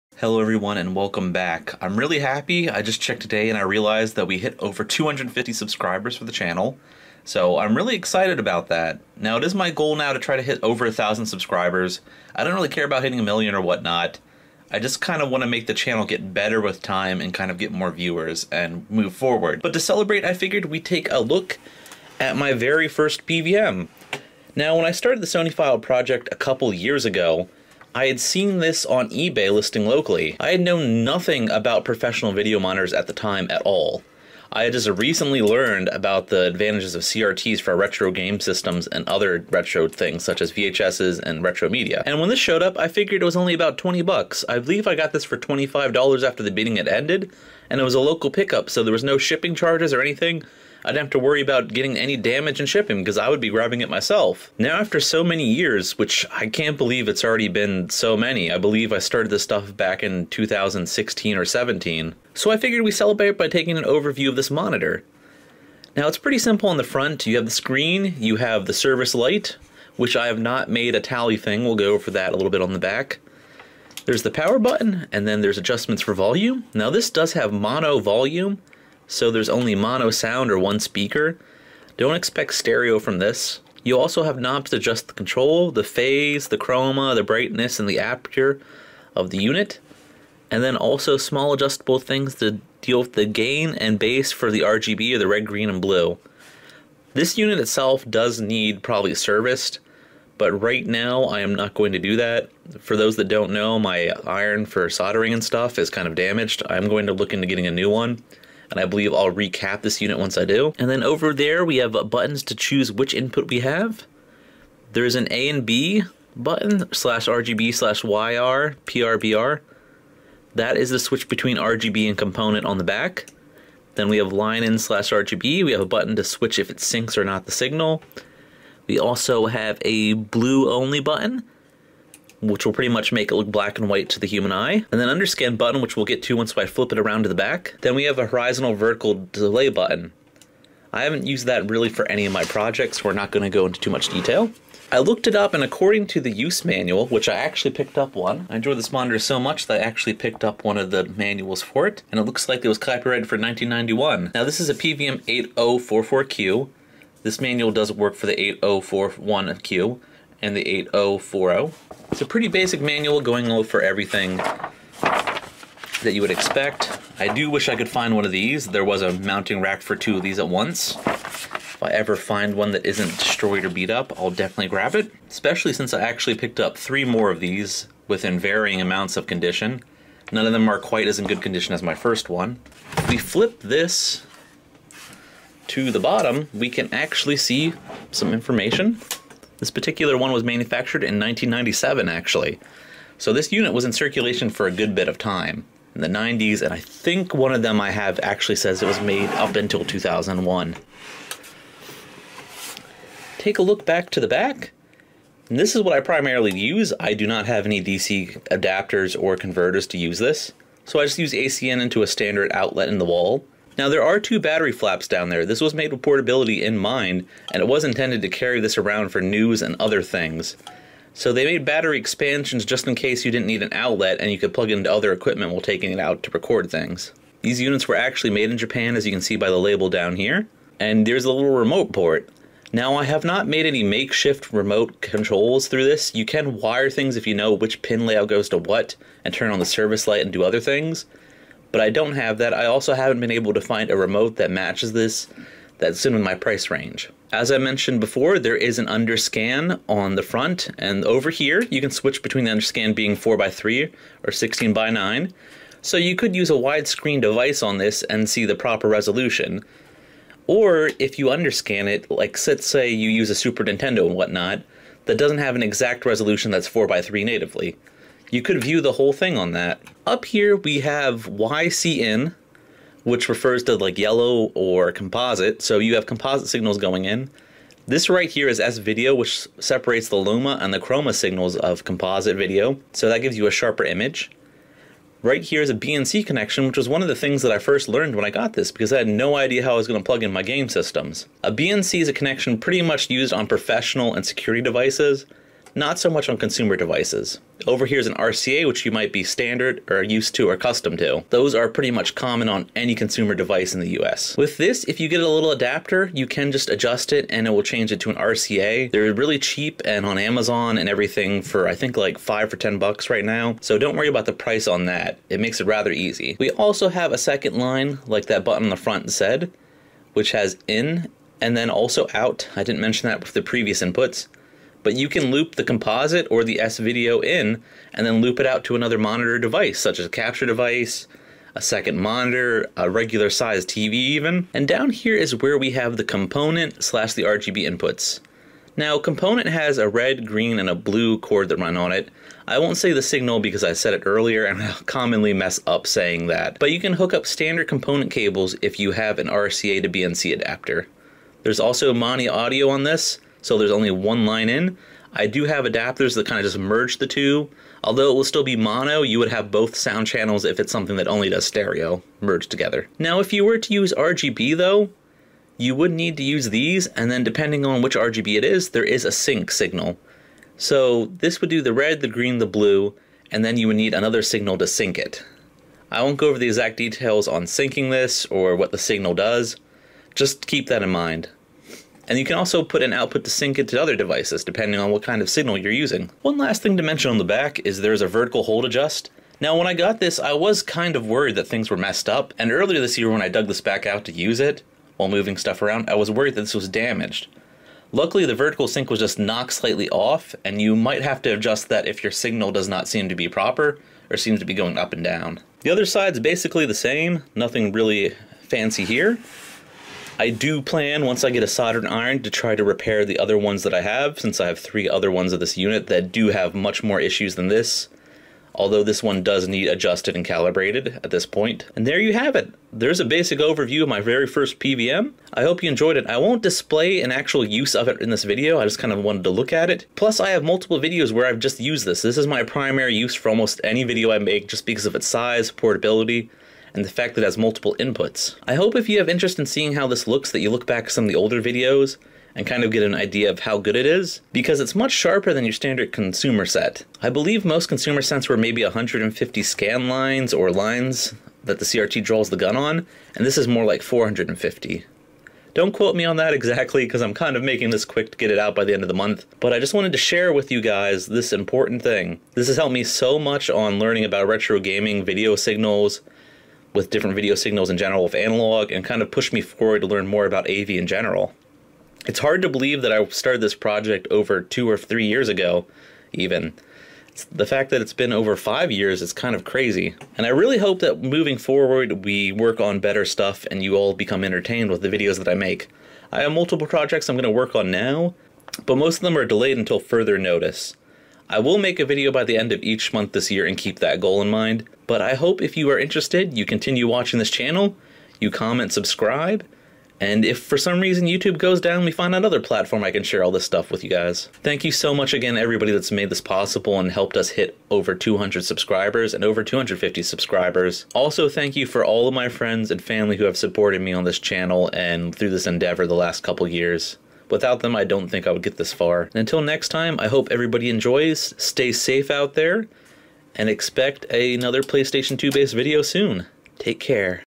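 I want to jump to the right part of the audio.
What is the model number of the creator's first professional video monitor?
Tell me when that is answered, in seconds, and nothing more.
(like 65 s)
154 s.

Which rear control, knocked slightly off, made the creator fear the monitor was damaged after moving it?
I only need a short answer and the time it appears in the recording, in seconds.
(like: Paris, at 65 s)
vertical hold adjust, at 388 s.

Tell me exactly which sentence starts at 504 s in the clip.
Thank you so much again, everybody that's made this possible and helped us hit over 200 subscribers and over 250 subscribers.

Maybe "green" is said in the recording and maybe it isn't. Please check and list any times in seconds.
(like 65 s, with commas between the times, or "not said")
95 s, 340 s, 372 s.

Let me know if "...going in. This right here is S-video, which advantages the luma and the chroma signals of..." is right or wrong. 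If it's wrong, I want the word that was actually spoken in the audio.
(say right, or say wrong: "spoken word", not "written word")
wrong: "separates", not "advantages".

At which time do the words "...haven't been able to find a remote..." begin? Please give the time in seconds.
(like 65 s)
242 s.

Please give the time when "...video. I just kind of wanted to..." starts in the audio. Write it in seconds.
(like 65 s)
428 s.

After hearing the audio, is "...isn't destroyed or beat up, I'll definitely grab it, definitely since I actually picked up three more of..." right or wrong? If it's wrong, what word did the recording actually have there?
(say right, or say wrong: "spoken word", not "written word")
wrong: "especially", not "definitely".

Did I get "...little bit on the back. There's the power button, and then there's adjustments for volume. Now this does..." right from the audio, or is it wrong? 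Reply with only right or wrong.
right.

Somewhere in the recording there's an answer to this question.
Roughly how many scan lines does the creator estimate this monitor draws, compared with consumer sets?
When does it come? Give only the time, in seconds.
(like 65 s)
453 s.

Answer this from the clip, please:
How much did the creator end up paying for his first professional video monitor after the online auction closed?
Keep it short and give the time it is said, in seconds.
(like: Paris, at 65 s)
$25, at 45 s.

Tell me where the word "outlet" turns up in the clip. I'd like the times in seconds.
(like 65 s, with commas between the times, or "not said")
212 s, 223 s.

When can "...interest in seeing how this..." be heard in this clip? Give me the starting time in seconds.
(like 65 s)
439 s.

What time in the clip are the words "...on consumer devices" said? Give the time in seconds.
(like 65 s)
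296 s.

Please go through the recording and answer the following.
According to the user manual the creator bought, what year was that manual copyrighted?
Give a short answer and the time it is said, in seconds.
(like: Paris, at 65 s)
1991, at 153 s.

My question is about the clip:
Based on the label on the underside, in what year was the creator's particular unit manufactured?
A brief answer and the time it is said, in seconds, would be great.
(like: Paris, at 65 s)
1997, at 191 s.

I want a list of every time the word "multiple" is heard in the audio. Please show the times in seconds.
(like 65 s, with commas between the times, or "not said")
430 s, 437 s, 486 s.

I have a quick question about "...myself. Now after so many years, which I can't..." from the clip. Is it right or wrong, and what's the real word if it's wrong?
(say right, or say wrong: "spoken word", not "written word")
right.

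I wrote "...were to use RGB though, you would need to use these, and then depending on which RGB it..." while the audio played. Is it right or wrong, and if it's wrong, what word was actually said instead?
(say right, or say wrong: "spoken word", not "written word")
right.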